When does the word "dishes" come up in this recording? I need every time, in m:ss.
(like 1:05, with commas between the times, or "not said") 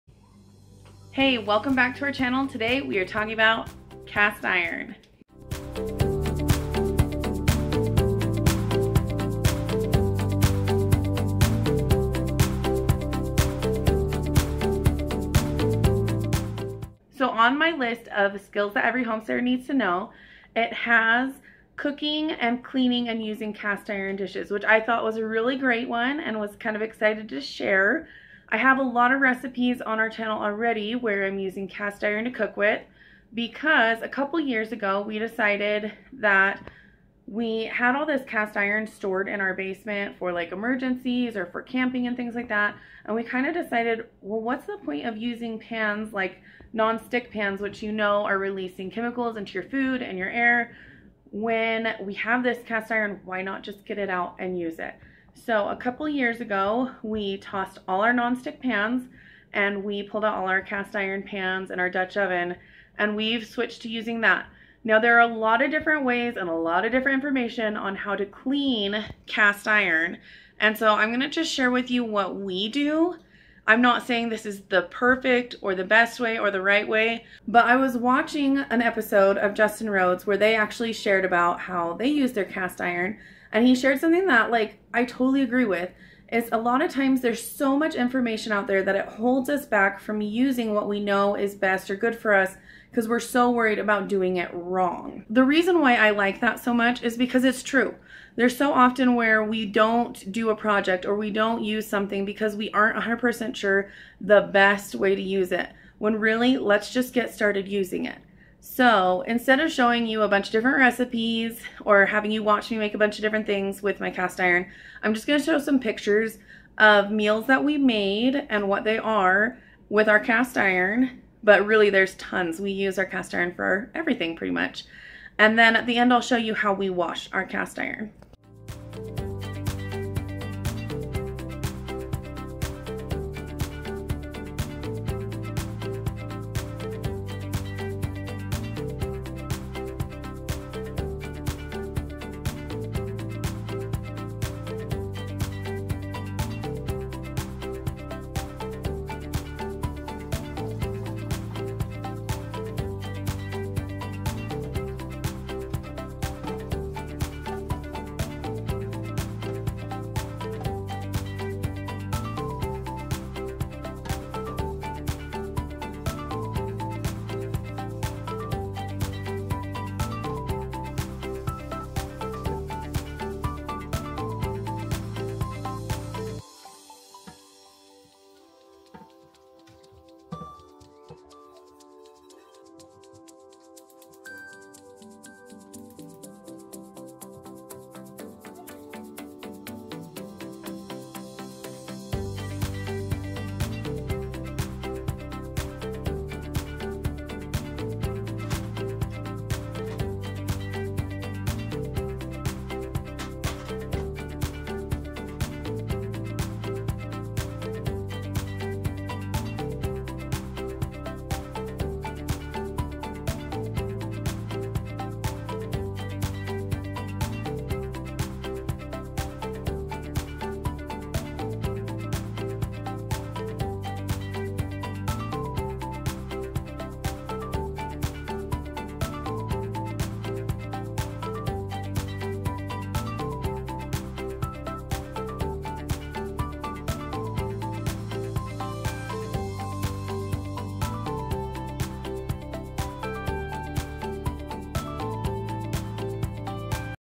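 0:24.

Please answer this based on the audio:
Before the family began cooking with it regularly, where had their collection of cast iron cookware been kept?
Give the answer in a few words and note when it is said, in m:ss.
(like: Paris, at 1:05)
basement, at 0:39.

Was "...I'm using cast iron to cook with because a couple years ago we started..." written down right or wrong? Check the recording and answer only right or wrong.
wrong.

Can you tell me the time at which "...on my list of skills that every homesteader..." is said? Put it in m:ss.
0:17.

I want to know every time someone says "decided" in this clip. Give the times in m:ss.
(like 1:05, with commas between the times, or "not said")
0:35, 0:43.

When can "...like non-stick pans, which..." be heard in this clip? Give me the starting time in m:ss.
0:46.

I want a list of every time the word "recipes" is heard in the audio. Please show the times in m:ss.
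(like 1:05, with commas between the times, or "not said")
0:29, 1:50.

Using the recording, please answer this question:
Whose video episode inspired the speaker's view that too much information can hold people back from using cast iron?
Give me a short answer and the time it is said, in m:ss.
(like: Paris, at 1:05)
Justin Rhodes, at 1:19.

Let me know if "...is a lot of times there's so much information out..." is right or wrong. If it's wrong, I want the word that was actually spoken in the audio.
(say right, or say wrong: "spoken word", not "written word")
right.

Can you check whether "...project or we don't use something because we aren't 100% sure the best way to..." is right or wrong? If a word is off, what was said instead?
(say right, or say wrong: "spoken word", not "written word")
right.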